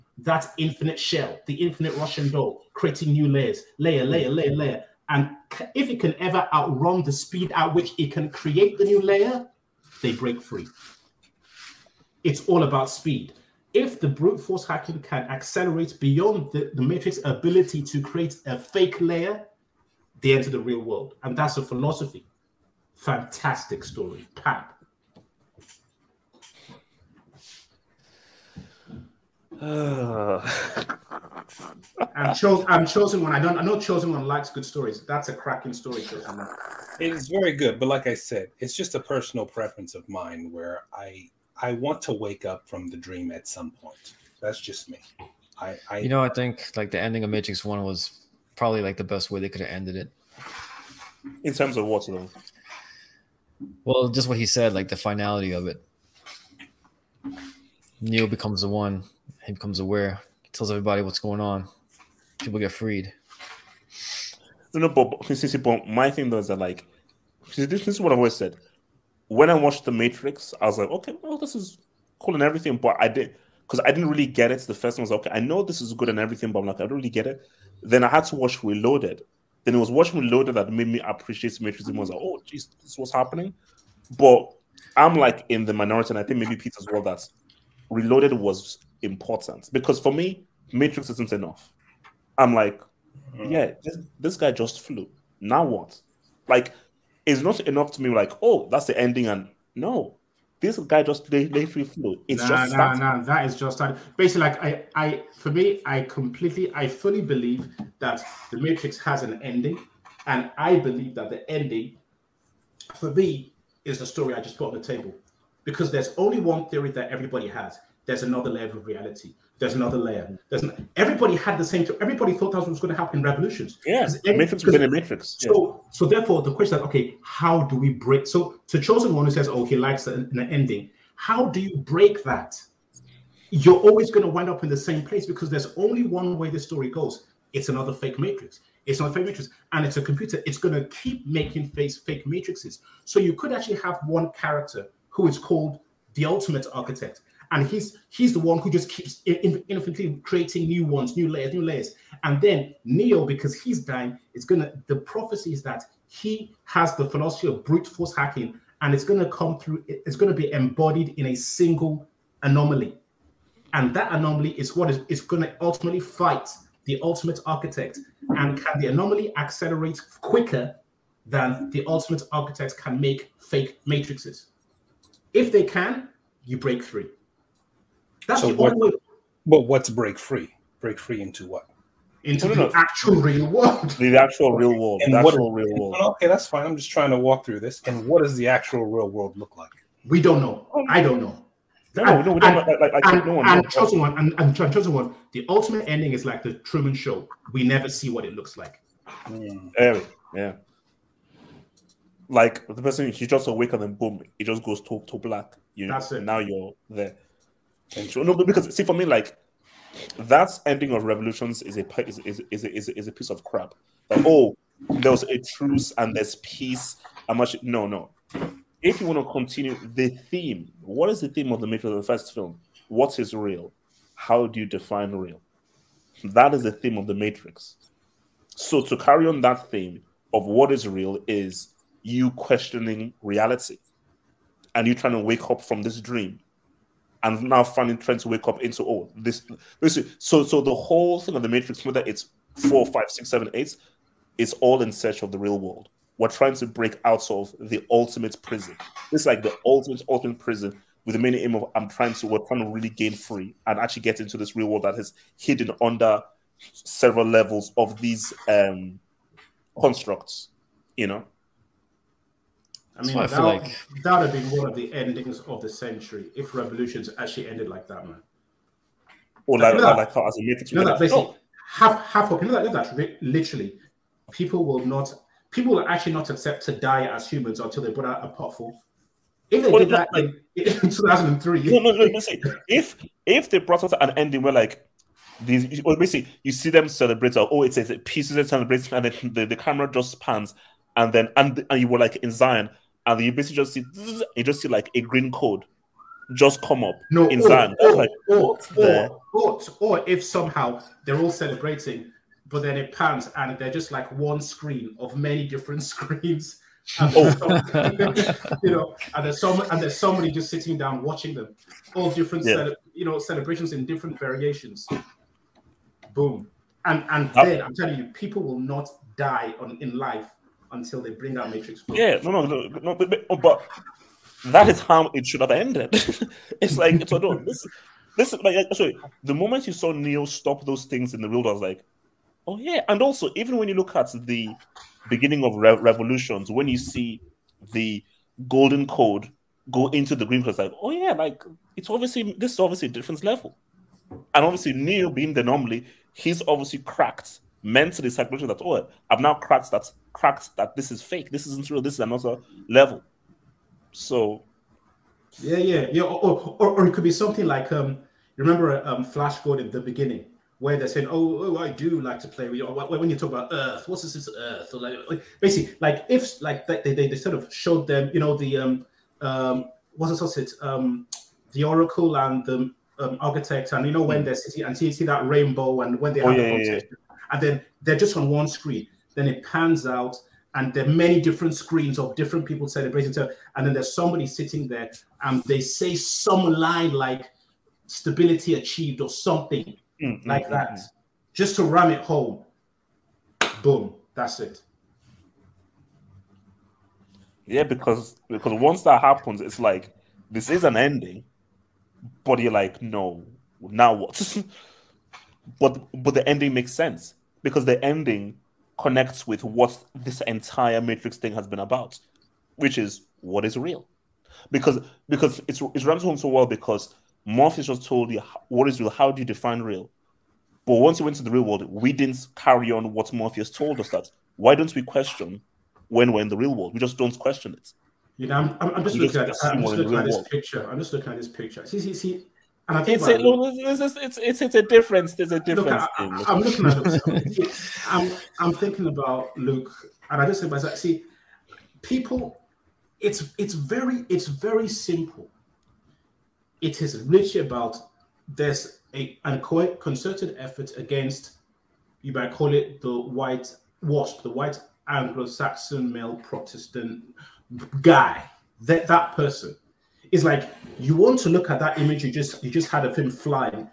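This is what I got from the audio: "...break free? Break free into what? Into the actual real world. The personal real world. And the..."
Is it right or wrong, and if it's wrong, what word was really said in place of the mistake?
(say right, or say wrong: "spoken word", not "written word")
wrong: "actual", not "personal".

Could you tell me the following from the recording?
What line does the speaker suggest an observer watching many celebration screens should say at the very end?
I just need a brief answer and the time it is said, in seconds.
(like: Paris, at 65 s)
stability achieved, at 387 s.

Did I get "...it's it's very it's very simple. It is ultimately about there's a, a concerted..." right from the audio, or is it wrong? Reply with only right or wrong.
wrong.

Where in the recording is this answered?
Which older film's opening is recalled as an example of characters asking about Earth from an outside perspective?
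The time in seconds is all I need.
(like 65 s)
359 s.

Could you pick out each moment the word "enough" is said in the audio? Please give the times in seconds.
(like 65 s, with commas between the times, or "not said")
91 s, 97 s.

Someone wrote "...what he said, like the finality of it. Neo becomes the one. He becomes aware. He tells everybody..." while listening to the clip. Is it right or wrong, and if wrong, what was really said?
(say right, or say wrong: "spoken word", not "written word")
right.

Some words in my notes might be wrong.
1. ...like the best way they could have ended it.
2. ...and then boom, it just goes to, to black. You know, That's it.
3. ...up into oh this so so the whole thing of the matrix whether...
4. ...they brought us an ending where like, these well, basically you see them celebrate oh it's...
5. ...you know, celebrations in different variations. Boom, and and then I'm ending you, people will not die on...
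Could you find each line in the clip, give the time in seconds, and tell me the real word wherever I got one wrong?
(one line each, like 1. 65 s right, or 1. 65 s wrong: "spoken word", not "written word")
1. 48 s right
2. 203 s right
3. 238 s right
4. 283 s right
5. 312 s wrong: "telling", not "ending".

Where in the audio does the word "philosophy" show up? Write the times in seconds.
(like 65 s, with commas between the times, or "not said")
21 s, 157 s.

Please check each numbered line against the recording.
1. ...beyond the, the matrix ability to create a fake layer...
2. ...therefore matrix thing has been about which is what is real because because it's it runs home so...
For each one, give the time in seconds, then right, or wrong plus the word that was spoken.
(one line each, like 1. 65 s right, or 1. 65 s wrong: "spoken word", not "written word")
1. 15 s right
2. 410 s wrong: "entire", not "therefore".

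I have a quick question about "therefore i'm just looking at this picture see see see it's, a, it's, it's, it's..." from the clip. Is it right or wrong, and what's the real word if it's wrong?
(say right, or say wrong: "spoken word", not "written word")
wrong: "picture", not "therefore".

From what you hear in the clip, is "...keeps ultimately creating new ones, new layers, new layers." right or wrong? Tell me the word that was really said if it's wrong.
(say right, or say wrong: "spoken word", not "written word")
wrong: "infinitely", not "ultimately".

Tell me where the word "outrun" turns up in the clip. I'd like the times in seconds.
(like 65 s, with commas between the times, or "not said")
6 s.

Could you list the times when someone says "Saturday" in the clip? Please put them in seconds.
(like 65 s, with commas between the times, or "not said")
not said.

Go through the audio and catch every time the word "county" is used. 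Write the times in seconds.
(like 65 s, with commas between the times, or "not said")
not said.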